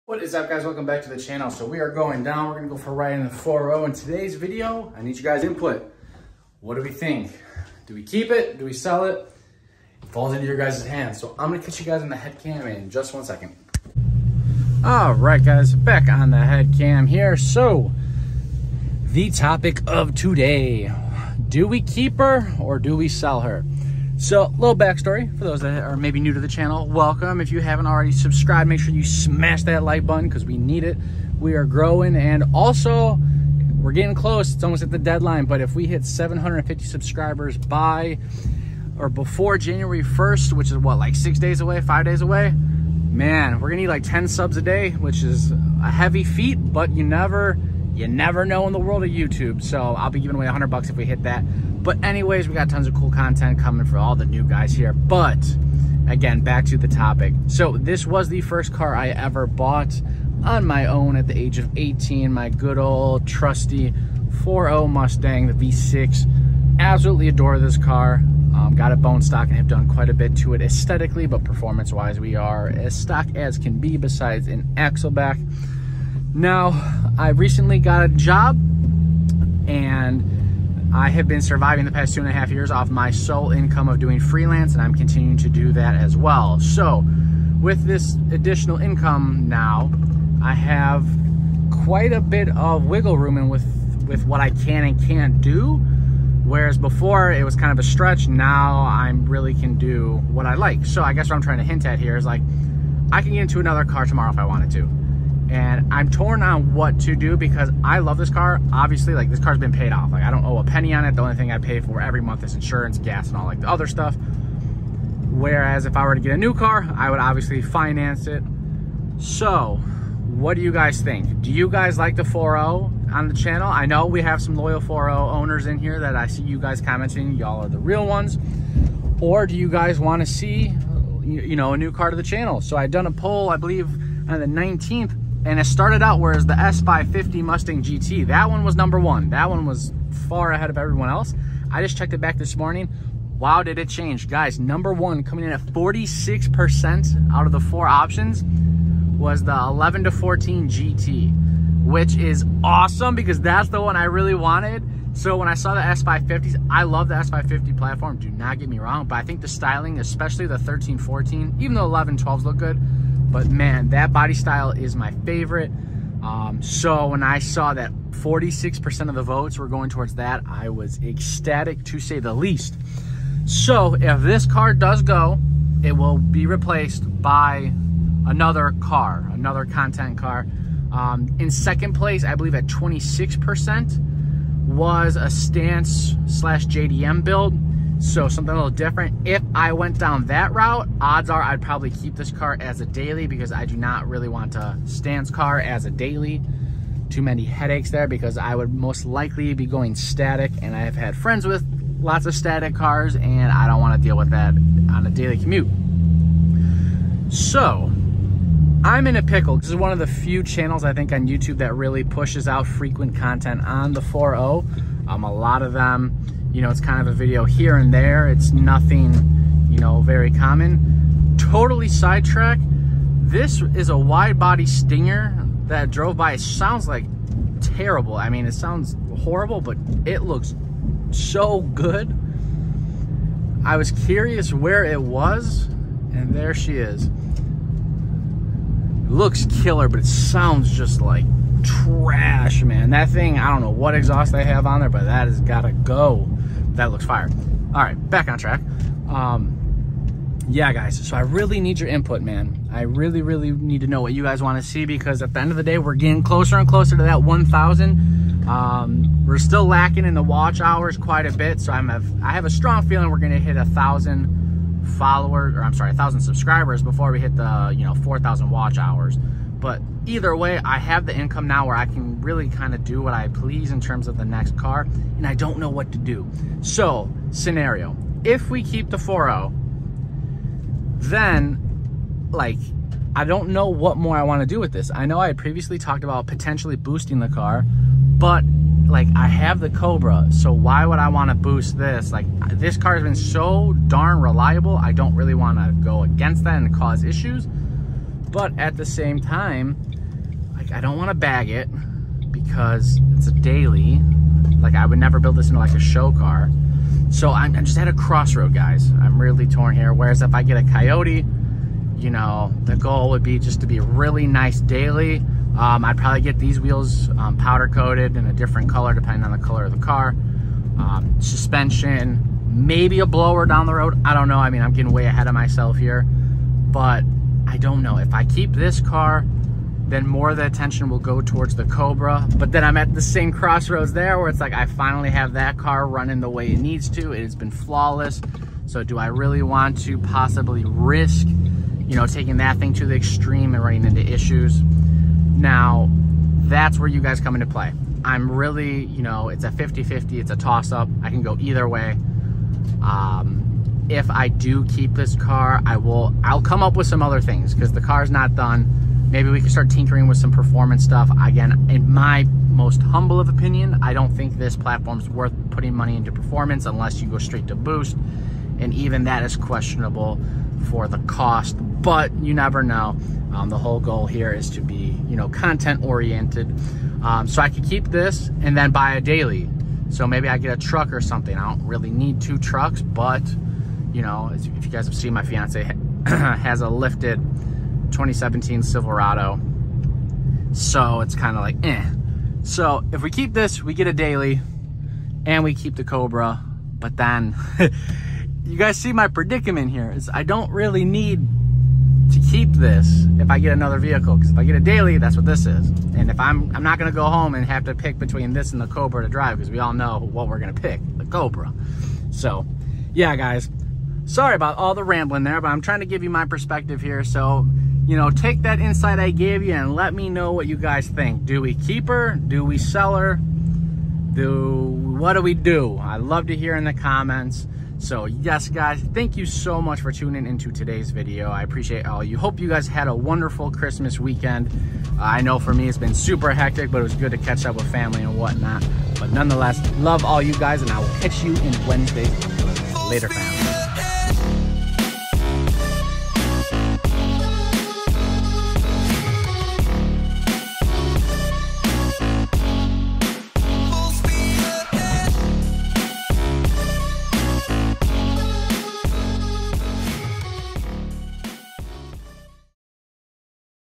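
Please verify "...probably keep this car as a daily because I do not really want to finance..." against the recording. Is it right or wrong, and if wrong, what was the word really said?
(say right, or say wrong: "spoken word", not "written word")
wrong: "stance", not "finance".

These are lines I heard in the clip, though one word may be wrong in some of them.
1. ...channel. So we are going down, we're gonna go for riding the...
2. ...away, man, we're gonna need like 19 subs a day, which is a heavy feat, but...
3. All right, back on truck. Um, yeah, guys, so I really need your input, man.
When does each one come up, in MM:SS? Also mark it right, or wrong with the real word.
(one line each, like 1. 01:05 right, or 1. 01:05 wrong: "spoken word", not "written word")
1. 00:01 right
2. 00:42 wrong: "10", not "19"
3. 04:07 wrong: "track", not "truck".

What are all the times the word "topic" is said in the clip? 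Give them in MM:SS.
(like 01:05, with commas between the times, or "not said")
00:19, 00:56.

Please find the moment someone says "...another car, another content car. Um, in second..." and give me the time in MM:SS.
02:58.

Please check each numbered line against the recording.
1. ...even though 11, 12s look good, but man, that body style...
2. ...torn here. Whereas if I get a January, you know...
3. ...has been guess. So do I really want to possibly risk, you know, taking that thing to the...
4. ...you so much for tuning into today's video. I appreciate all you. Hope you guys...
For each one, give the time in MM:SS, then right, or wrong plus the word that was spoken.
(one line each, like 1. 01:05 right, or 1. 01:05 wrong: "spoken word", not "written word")
1. 02:41 right
2. 05:09 wrong: "Coyote", not "January"
3. 05:37 wrong: "flawless", not "guess"
4. 07:09 right.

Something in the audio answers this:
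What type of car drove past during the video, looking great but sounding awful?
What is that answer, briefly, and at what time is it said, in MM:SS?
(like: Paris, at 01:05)
A wide body Stinger, at 03:43.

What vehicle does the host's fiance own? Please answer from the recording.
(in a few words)
A lifted 2017 Silverado.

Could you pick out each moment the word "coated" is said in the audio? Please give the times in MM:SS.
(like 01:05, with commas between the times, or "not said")
05:17.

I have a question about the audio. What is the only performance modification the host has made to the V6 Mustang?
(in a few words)
An axle back.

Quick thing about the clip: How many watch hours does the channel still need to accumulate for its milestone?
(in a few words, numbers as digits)
4,000.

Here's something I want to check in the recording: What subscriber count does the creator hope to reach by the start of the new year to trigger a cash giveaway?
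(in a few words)
750.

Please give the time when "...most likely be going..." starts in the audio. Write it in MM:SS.
03:18.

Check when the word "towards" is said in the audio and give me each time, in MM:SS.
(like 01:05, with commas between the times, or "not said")
02:49, 05:31.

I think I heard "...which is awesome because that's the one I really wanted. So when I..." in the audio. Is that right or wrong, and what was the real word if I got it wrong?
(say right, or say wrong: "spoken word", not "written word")
right.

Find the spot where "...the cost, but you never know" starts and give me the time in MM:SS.
06:10.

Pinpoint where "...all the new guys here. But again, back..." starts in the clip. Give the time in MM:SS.
00:53.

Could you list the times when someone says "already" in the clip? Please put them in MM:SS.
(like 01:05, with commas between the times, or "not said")
00:27.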